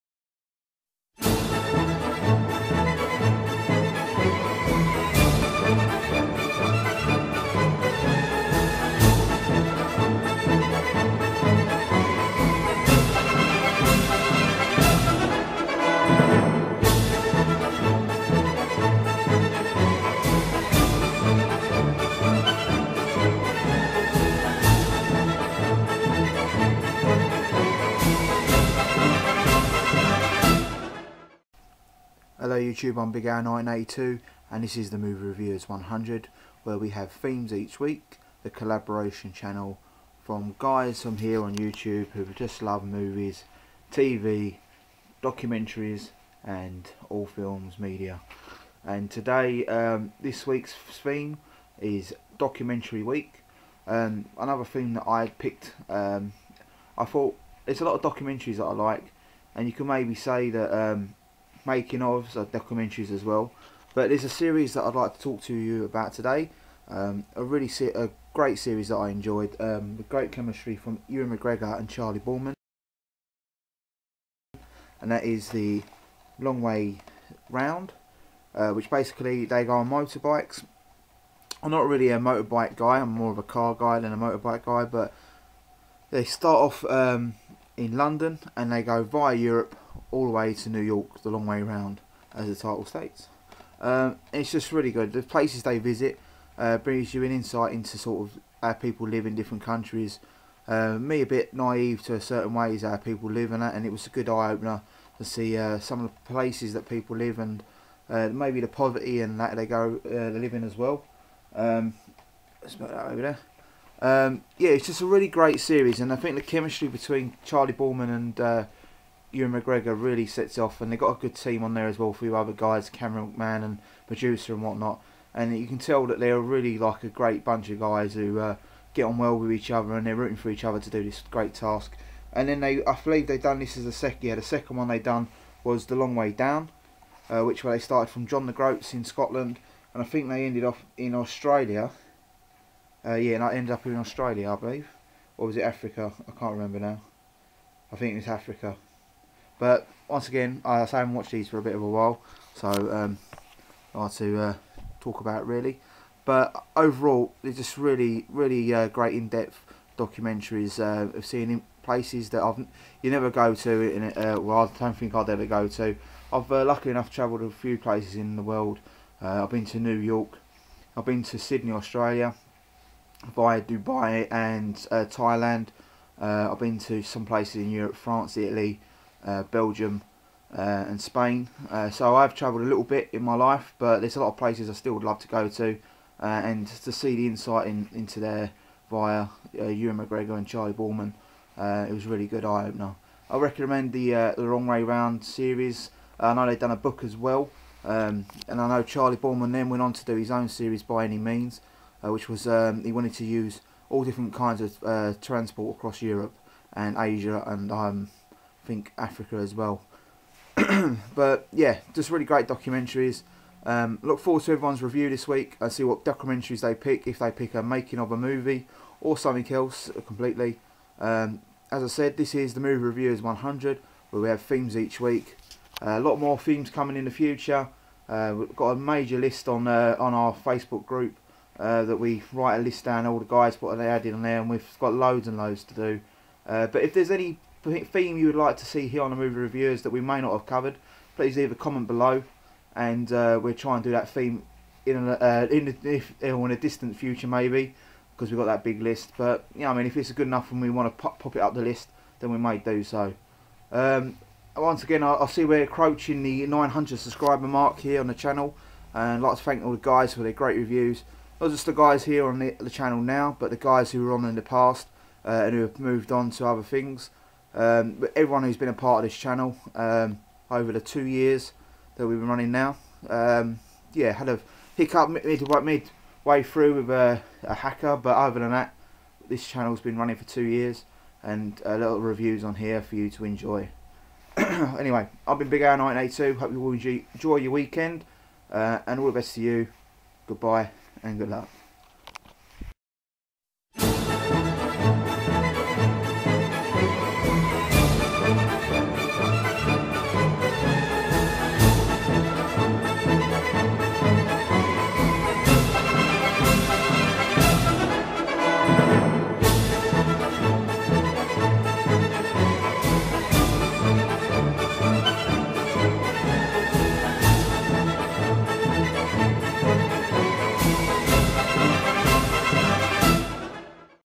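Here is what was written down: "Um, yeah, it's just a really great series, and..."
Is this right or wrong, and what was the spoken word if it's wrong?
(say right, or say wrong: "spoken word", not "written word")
right.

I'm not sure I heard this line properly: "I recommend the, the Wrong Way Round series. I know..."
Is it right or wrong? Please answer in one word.
right.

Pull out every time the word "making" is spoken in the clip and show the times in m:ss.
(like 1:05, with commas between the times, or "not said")
1:01, 3:37.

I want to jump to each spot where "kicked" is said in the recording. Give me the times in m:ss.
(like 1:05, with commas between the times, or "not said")
not said.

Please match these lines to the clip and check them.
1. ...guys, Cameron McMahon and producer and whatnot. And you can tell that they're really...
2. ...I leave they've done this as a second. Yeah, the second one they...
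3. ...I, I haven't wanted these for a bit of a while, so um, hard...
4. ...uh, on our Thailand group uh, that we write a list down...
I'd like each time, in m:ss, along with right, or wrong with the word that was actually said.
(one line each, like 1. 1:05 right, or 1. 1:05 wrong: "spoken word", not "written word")
1. 2:02 right
2. 2:12 wrong: "believe", not "leave"
3. 2:30 wrong: "watched", not "wanted"
4. 3:49 wrong: "Facebook", not "Thailand".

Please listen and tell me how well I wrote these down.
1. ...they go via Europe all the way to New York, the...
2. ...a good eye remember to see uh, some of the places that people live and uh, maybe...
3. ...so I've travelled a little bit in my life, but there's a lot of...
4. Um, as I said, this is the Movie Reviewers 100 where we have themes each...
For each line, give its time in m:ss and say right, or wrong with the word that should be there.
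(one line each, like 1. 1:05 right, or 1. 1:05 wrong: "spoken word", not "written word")
1. 1:28 right
2. 1:44 wrong: "opener", not "remember"
3. 3:01 right
4. 3:40 right.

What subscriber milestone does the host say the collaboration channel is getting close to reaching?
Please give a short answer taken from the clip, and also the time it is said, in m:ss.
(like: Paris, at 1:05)
900, at 4:16.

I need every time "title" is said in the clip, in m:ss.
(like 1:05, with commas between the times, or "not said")
1:32.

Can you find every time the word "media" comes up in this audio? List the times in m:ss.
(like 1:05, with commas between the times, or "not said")
0:47.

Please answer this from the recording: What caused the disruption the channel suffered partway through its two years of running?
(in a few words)
a hacker.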